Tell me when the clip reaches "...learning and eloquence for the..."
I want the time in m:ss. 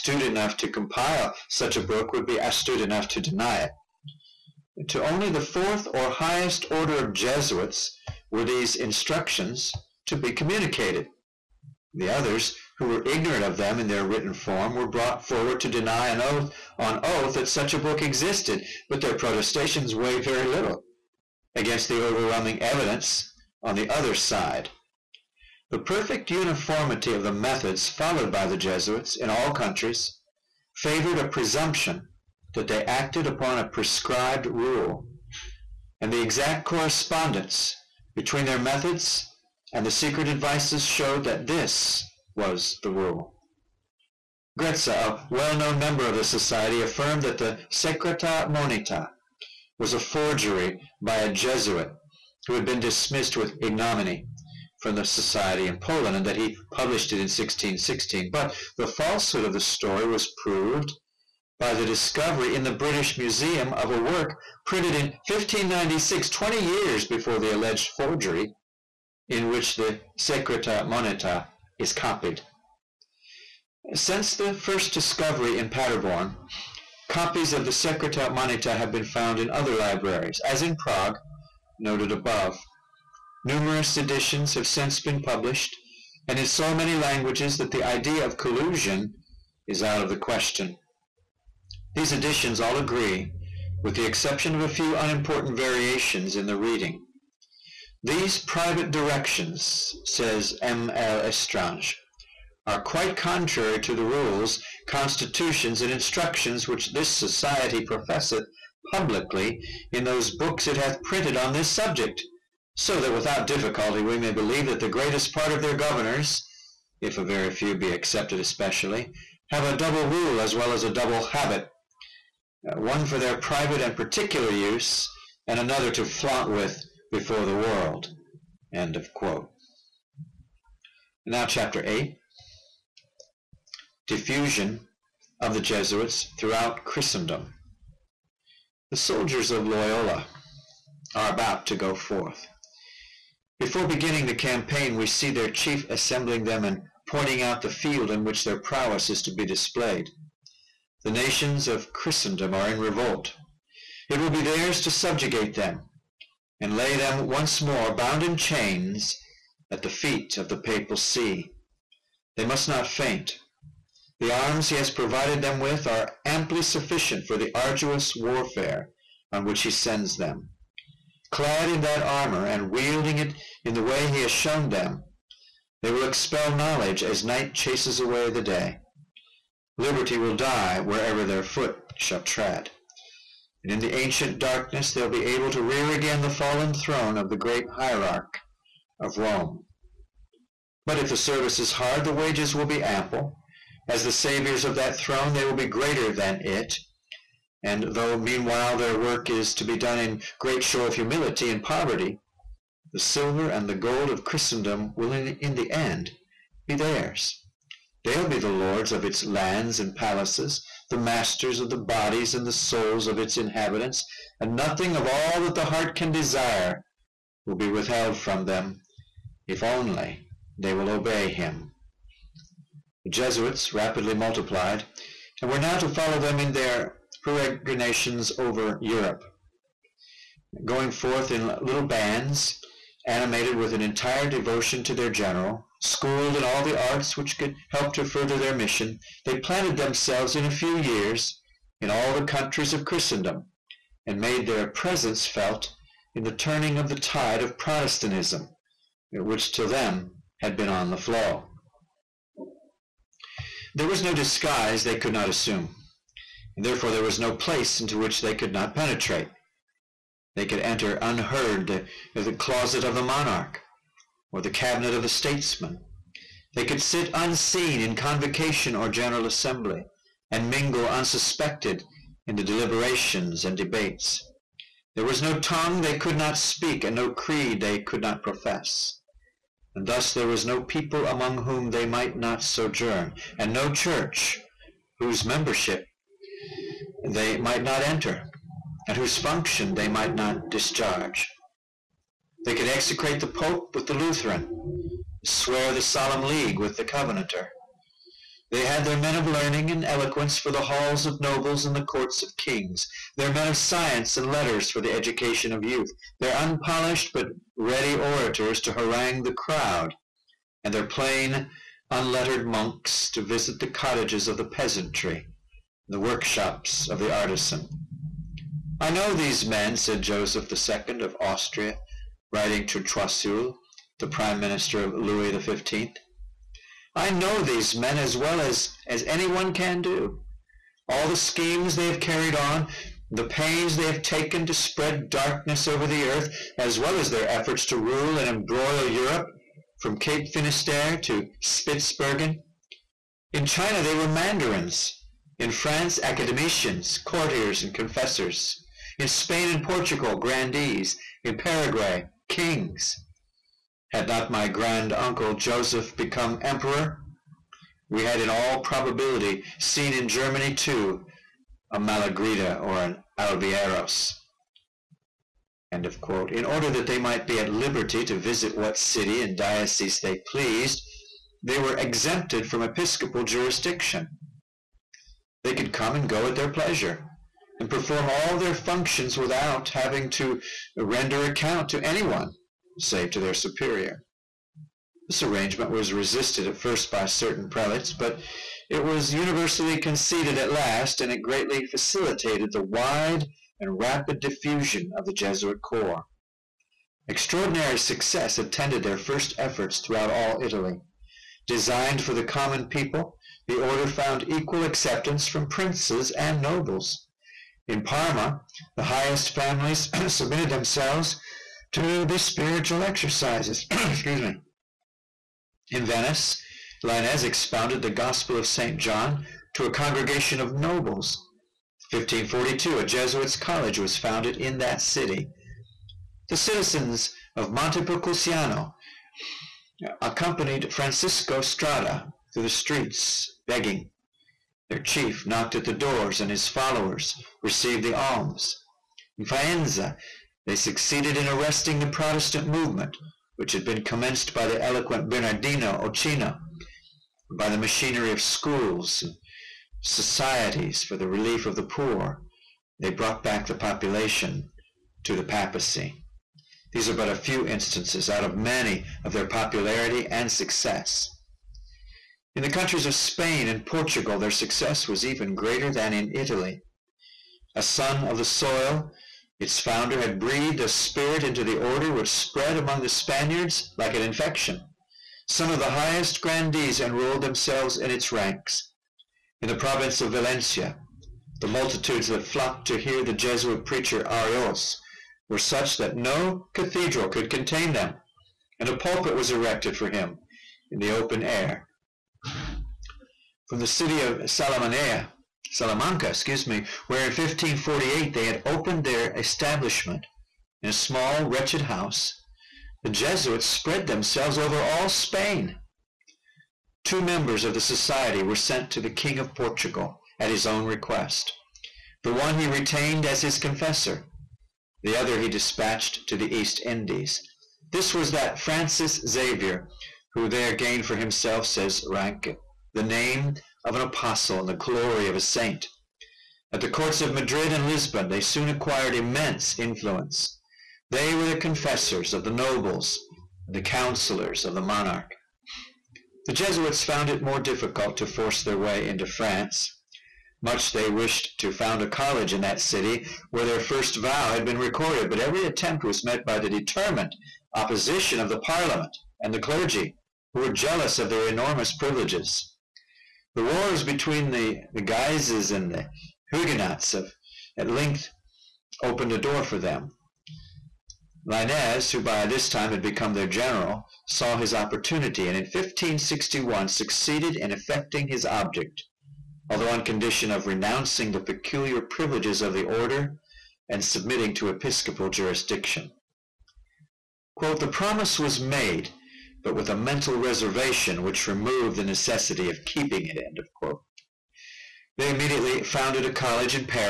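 4:59.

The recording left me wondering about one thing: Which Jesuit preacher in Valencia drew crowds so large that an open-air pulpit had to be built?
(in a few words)
Araoz.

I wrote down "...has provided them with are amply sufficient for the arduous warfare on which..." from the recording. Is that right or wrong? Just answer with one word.
right.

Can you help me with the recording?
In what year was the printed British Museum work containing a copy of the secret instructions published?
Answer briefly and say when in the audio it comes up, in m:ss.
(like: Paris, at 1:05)
1596, at 1:05.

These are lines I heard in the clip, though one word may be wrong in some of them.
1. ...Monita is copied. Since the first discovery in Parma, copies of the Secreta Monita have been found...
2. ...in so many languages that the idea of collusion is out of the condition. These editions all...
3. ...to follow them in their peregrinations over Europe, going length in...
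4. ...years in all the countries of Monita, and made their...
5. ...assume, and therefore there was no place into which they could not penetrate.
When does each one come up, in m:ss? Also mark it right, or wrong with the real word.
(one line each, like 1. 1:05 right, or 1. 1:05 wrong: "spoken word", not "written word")
1. 1:10 wrong: "Paderborn", not "Parma"
2. 1:26 wrong: "question", not "condition"
3. 3:45 wrong: "forth", not "length"
4. 4:00 wrong: "Christendom", not "Monita"
5. 4:15 right.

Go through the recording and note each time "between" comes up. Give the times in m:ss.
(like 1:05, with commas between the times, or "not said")
0:38, 9:13.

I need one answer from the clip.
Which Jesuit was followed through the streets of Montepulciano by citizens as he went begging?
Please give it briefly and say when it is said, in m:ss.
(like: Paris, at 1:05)
Francisco Strada, at 7:10.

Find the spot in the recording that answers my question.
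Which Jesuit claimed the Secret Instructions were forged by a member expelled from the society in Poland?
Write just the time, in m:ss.
0:44.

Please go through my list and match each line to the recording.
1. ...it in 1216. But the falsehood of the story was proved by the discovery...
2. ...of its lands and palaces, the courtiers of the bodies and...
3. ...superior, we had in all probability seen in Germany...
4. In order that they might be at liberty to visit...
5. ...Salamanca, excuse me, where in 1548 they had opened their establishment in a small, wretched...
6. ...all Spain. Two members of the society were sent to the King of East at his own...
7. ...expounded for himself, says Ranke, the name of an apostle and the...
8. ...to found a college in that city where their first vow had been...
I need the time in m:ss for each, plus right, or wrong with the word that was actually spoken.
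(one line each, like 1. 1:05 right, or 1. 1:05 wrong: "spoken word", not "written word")
1. 0:57 wrong: "1616", not "1216"
2. 3:28 wrong: "masters", not "courtiers"
3. 5:56 wrong: "emperor", not "superior"
4. 6:05 right
5. 8:15 right
6. 8:24 wrong: "Portugal", not "East"
7. 8:40 wrong: "gained", not "expounded"
8. 9:01 right.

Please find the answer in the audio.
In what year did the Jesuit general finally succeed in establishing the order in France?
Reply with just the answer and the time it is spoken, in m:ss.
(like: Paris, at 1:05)
1561, at 9:25.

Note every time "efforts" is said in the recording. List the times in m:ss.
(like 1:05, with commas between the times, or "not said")
5:37, 6:39.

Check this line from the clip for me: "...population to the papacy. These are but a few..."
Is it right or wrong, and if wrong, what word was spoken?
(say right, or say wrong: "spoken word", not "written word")
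right.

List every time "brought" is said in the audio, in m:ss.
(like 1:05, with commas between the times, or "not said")
0:14, 7:32.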